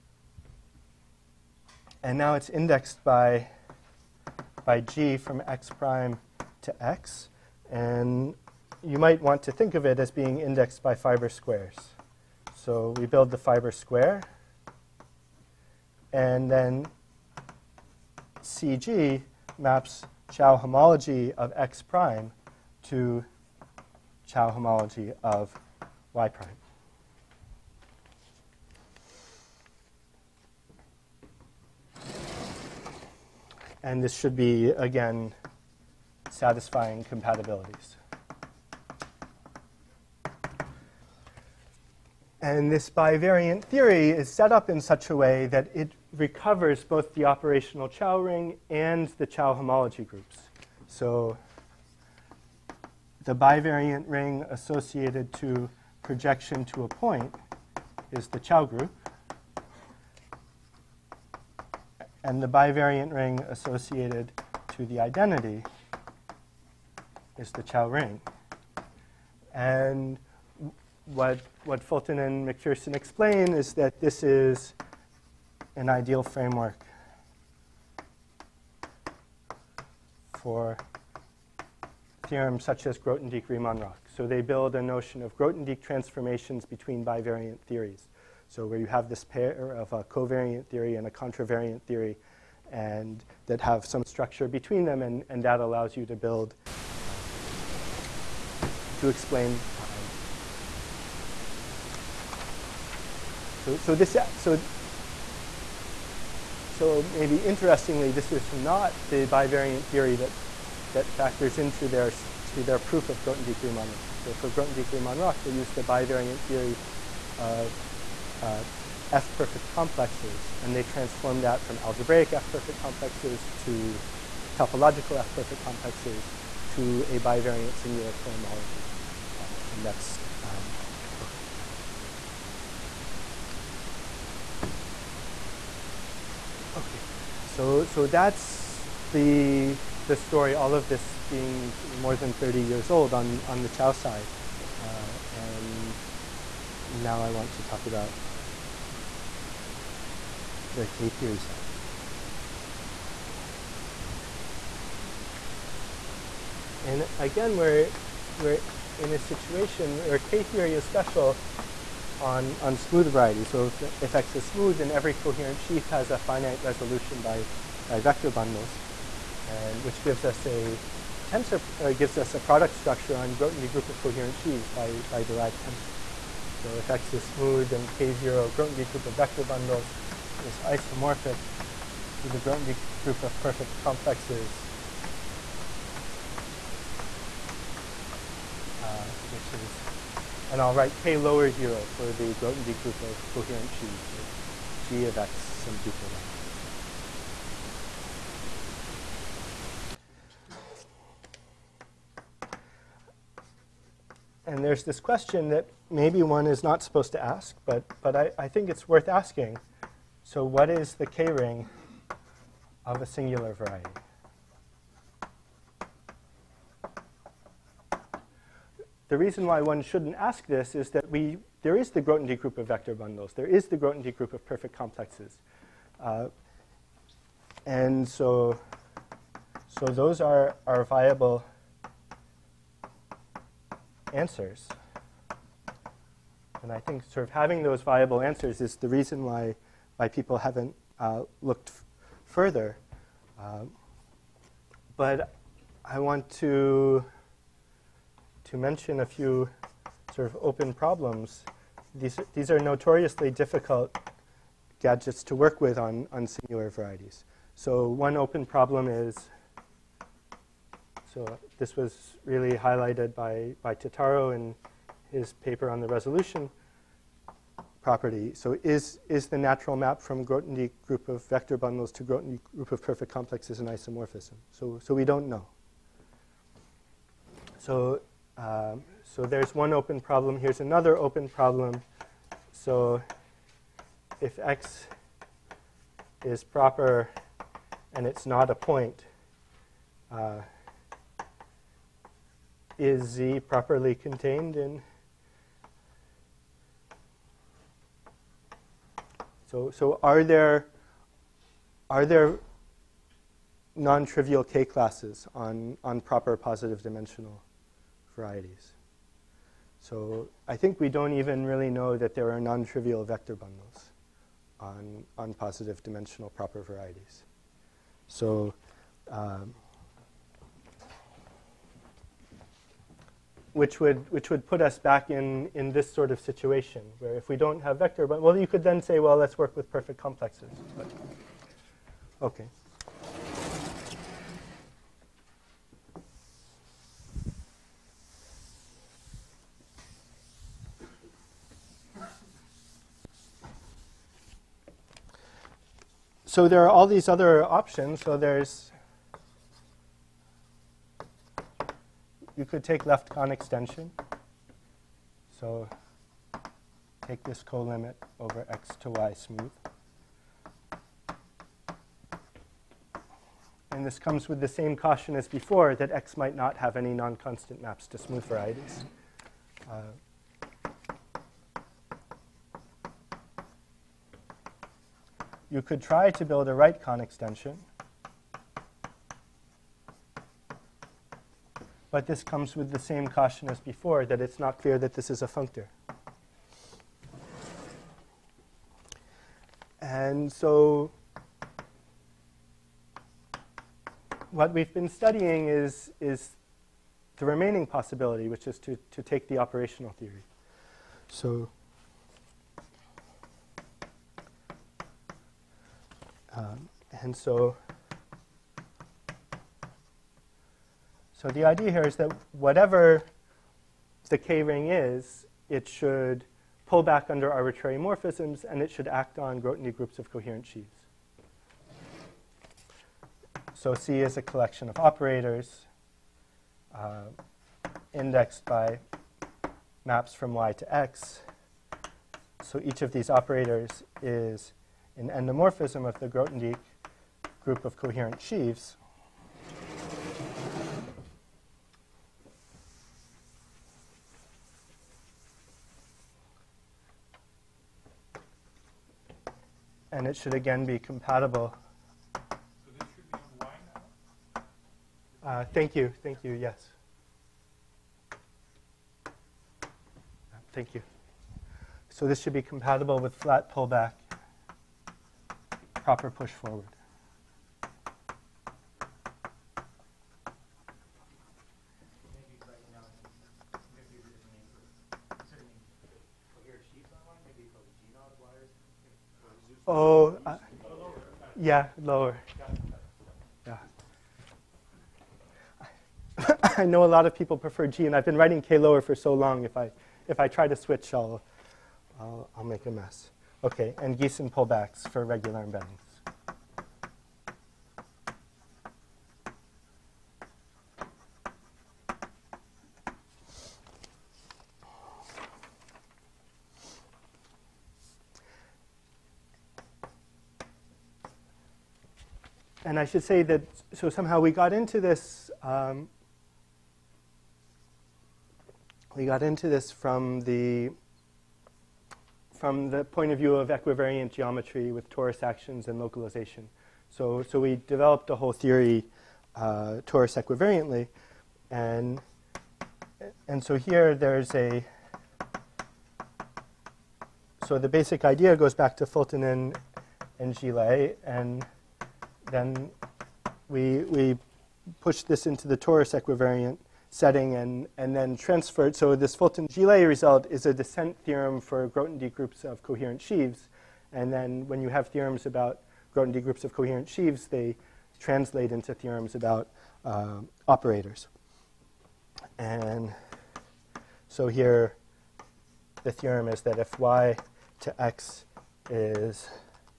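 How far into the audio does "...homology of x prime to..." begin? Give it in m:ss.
0:20.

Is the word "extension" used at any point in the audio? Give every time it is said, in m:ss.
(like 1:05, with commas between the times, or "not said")
5:53, 6:16.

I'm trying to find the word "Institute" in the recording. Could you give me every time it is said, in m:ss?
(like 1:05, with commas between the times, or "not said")
not said.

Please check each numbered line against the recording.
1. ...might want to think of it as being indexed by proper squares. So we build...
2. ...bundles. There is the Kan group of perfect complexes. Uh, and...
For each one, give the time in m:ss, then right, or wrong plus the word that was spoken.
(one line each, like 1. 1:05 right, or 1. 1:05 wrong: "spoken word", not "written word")
1. 0:08 wrong: "fiber", not "proper"
2. 3:42 wrong: "Grothendieck", not "Kan".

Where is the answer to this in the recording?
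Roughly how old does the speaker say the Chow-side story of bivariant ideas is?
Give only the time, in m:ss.
2:21.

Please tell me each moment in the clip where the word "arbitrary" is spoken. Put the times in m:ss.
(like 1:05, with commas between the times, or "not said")
6:57.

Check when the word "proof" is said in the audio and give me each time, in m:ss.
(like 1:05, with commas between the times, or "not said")
1:52.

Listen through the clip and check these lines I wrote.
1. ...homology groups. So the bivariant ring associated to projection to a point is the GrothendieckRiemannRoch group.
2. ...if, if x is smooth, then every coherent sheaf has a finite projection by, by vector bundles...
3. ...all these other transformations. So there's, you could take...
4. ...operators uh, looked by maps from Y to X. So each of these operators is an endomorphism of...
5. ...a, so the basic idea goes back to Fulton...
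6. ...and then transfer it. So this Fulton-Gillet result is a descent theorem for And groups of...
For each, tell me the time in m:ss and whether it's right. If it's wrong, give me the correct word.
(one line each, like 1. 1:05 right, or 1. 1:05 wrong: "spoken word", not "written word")
1. 0:49 wrong: "Chow", not "GrothendieckRiemannRoch"
2. 2:43 wrong: "resolution", not "projection"
3. 5:46 wrong: "options", not "transformations"
4. 7:04 wrong: "indexed", not "looked"
5. 8:54 right
6. 9:07 wrong: "Grothendieck", not "And".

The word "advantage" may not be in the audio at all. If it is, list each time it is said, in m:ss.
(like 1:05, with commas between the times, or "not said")
not said.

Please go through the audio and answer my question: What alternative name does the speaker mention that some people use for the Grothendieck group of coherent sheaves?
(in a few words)
G of X.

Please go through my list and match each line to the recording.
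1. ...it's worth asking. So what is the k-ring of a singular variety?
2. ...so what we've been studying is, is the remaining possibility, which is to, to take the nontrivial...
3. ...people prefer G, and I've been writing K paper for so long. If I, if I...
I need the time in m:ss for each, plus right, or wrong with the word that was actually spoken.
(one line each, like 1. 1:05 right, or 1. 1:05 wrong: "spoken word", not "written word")
1. 3:28 right
2. 6:30 wrong: "operational", not "nontrivial"
3. 8:07 wrong: "lower", not "paper".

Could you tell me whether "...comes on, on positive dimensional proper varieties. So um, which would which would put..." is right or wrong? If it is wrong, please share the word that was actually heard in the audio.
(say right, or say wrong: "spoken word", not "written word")
wrong: "bundles", not "comes".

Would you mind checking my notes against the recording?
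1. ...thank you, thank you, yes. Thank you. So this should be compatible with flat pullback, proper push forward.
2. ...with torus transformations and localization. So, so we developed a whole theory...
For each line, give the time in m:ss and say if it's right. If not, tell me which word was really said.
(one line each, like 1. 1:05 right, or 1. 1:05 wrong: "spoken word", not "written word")
1. 7:35 right
2. 8:44 wrong: "actions", not "transformations".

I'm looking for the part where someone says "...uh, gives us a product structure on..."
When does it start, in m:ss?
2:51.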